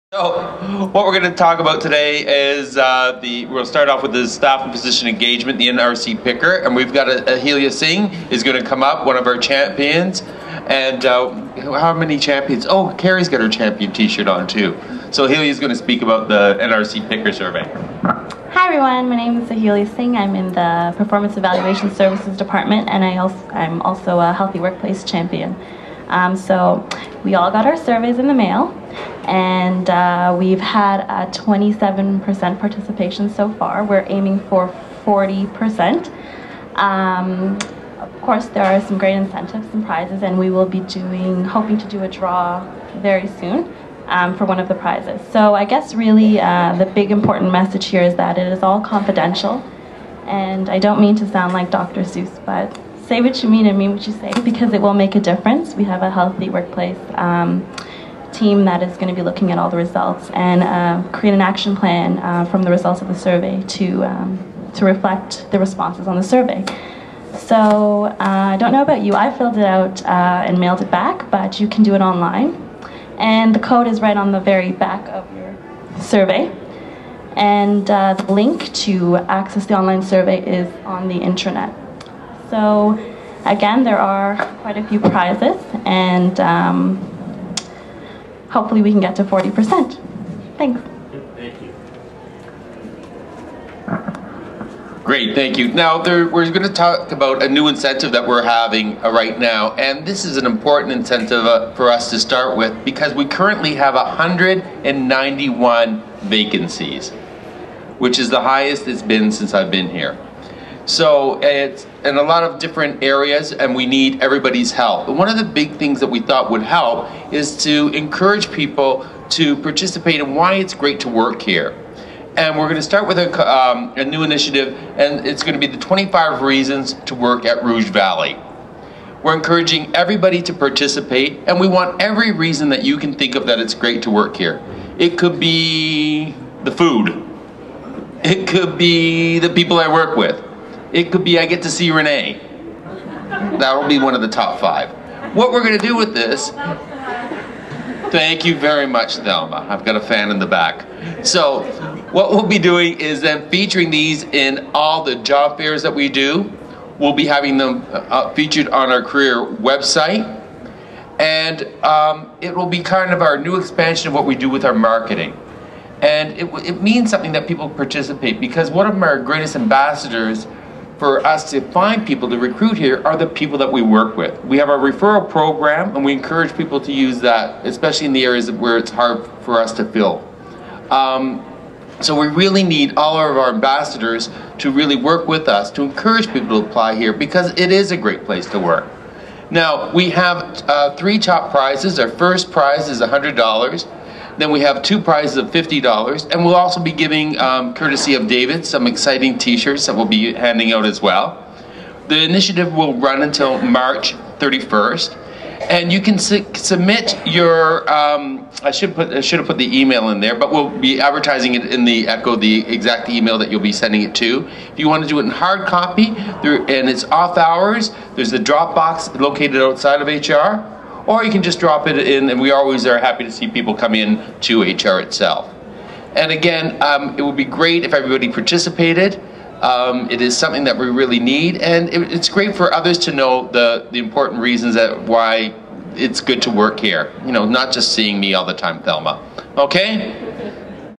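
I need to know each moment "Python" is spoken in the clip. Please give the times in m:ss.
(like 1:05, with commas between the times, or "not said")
not said.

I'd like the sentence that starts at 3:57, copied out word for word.
You know, not just seeing me all the time, Thelma.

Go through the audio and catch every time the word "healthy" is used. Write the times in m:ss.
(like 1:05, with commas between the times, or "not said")
0:24, 0:56.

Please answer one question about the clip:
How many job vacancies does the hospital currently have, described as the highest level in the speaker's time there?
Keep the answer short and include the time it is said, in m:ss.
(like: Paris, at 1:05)
191, at 1:43.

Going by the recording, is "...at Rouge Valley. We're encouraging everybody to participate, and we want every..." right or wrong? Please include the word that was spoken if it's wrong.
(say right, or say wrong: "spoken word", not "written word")
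right.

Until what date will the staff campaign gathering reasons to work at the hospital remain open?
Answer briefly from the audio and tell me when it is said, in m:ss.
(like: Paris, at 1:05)
March 31st, at 3:23.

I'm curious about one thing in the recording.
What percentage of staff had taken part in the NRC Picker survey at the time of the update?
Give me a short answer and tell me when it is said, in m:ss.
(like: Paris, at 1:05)
27%, at 0:31.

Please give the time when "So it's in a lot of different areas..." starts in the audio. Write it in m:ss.
1:50.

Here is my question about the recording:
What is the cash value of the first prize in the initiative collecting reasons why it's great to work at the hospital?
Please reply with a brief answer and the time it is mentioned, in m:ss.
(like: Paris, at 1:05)
$100, at 3:13.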